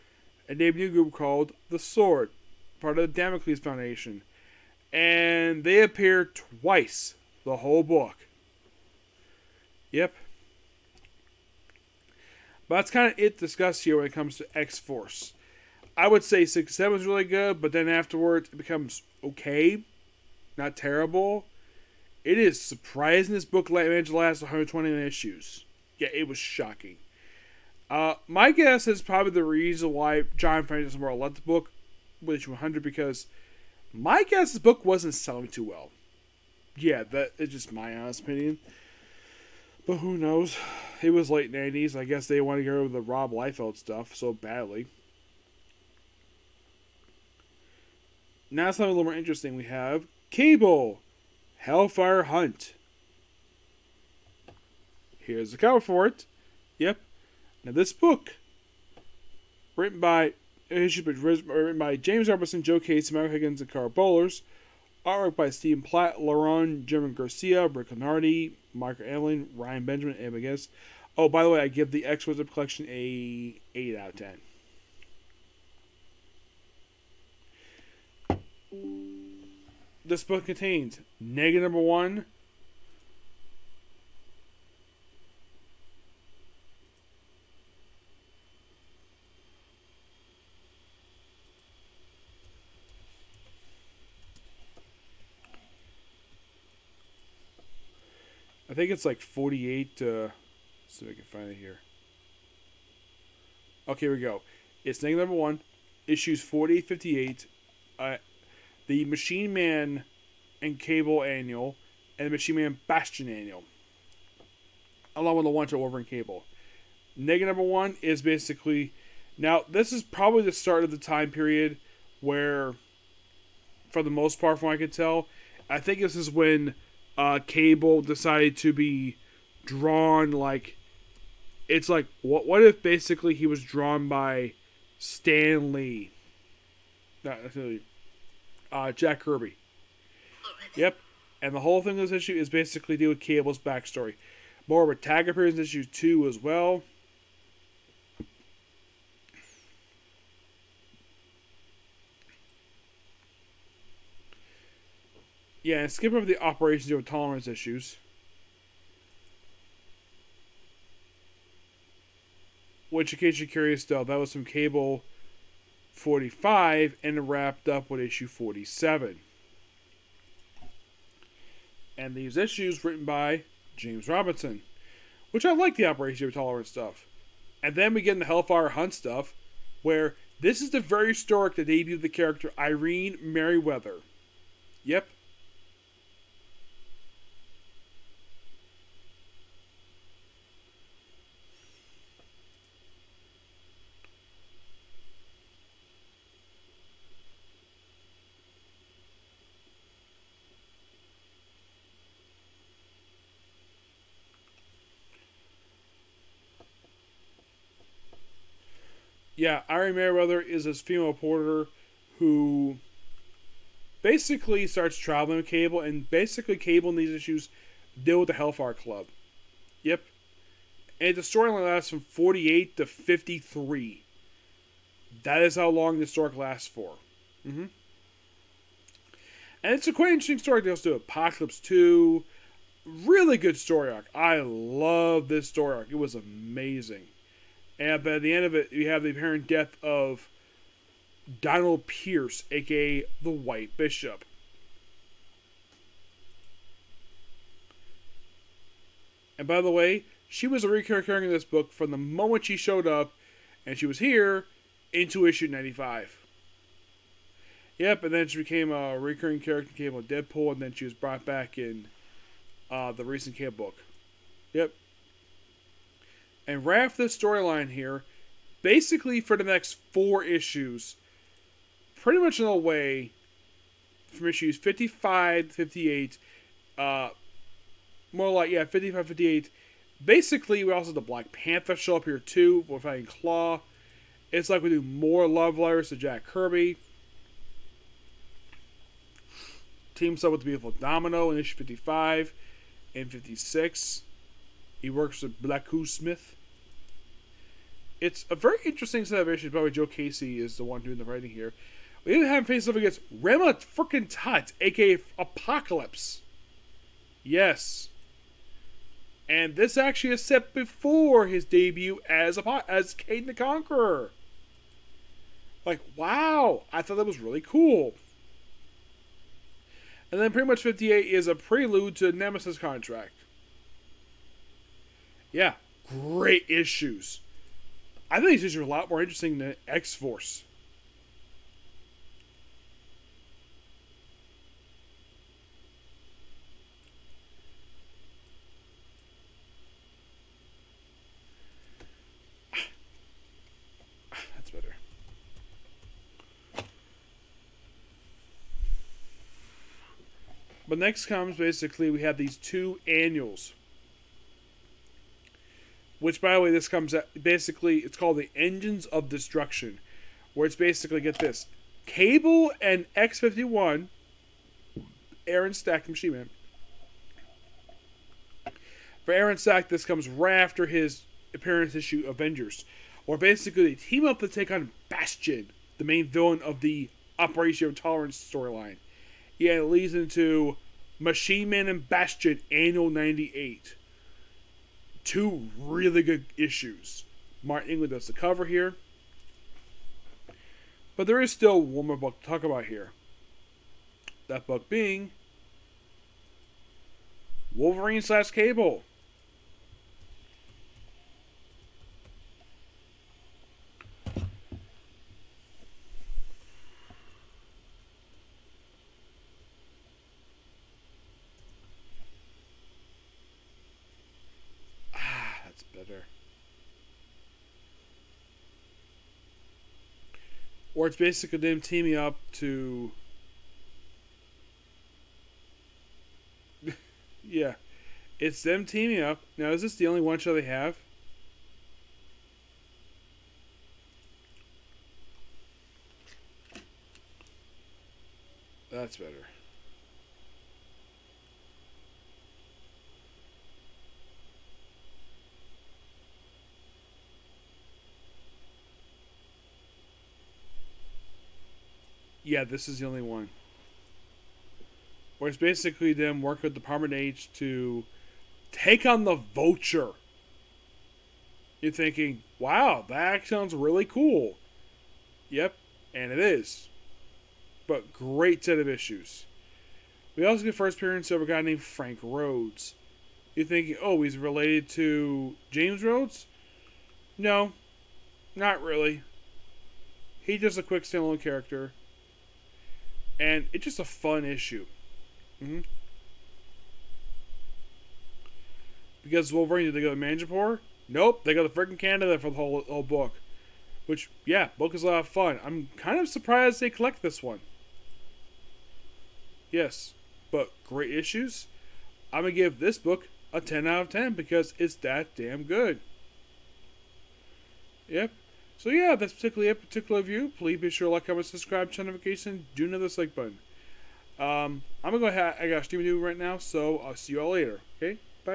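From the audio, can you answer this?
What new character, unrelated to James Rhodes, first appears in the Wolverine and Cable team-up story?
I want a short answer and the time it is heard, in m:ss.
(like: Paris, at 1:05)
Frank Rhodes, at 7:51.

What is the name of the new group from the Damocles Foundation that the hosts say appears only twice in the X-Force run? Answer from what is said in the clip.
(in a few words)
The Sword.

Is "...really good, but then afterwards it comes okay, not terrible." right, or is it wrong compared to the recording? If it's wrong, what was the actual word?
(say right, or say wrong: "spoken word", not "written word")
wrong: "becomes", not "comes".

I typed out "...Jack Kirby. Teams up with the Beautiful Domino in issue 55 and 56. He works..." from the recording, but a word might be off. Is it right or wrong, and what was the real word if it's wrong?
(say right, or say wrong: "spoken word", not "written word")
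right.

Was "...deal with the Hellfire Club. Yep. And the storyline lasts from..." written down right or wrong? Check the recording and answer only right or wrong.
right.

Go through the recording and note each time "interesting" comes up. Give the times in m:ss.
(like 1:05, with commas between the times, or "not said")
0:49, 3:50, 4:58, 5:29.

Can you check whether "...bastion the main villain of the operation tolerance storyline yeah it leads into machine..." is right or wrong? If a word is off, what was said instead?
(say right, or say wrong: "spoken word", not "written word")
right.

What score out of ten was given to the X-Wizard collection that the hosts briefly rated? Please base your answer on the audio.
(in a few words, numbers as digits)
8.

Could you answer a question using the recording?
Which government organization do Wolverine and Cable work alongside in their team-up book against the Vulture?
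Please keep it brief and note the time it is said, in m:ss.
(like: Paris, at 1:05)
Department H, at 7:36.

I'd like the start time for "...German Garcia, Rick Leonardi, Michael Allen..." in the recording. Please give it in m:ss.
1:06.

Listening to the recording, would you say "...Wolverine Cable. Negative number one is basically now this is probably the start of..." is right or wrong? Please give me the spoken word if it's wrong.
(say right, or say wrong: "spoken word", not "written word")
right.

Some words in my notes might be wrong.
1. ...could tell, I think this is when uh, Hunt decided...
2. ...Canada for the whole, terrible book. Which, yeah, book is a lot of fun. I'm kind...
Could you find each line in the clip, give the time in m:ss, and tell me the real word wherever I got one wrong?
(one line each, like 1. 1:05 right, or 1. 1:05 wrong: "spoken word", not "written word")
1. 2:04 wrong: "Cable", not "Hunt"
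2. 8:11 wrong: "whole", not "terrible".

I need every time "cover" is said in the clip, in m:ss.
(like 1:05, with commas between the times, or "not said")
0:55, 6:28.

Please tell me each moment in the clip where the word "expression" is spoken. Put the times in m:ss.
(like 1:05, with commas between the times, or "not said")
not said.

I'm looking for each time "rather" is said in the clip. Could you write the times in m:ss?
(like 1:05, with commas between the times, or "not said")
not said.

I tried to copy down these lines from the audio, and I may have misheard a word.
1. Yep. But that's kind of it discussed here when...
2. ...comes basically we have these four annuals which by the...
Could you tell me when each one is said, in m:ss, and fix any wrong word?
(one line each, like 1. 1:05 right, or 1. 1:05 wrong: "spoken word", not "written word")
1. 0:09 right
2. 5:51 wrong: "two", not "four".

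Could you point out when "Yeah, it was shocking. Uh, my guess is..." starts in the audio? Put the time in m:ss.
0:25.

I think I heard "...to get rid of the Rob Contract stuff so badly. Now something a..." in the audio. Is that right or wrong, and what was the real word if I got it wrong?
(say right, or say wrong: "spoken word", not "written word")
wrong: "Liefeld", not "Contract".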